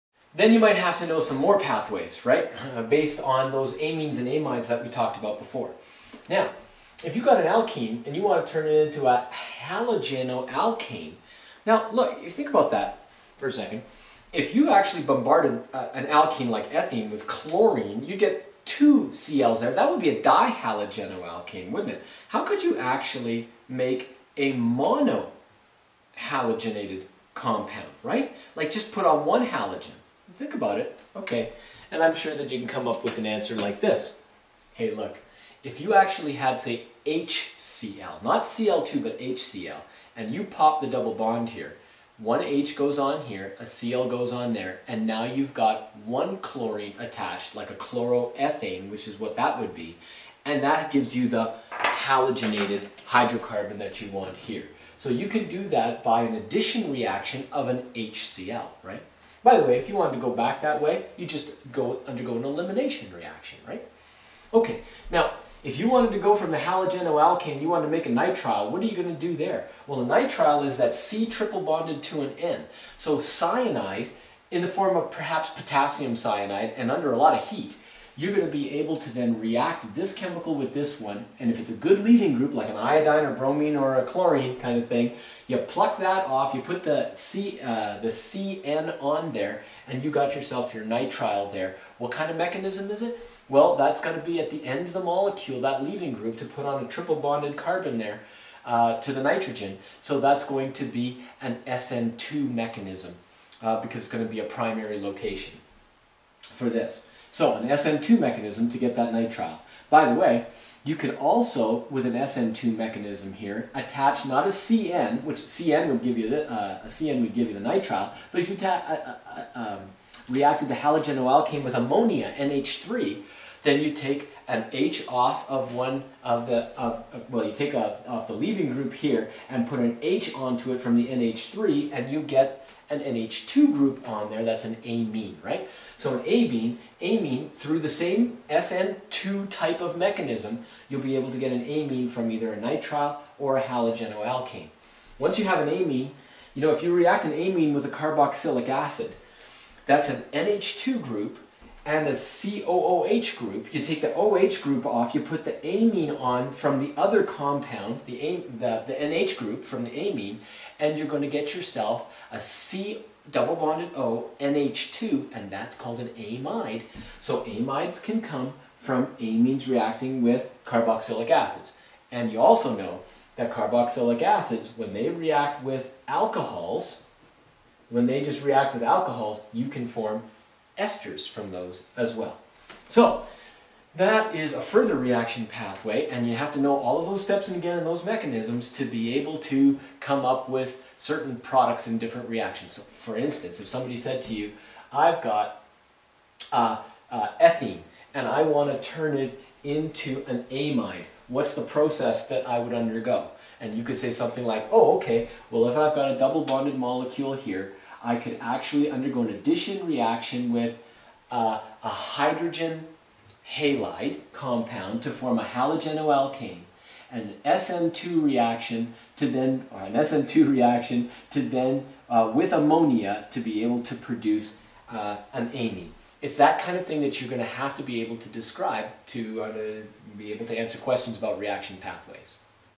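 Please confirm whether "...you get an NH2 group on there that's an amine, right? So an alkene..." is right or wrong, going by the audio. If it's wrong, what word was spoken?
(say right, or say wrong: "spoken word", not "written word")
wrong: "amine", not "alkene".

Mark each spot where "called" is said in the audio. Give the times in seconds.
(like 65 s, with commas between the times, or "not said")
165 s.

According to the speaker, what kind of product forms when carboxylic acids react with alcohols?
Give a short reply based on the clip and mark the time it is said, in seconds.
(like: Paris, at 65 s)
Esters, at 180 s.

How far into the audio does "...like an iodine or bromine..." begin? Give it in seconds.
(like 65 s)
82 s.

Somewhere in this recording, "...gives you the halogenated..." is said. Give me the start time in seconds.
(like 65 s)
50 s.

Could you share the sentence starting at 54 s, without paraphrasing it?
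So you can do that by an addition reaction of an HCl, right?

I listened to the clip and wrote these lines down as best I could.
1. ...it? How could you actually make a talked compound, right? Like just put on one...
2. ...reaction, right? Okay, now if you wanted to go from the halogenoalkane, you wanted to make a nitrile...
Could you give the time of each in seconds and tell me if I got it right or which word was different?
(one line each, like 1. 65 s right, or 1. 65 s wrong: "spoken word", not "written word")
1. 21 s wrong: "monohalogenated", not "talked"
2. 63 s right.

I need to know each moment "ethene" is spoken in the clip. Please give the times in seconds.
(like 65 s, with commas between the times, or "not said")
16 s, 197 s.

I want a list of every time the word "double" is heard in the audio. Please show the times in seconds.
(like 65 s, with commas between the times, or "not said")
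40 s, 163 s, 206 s.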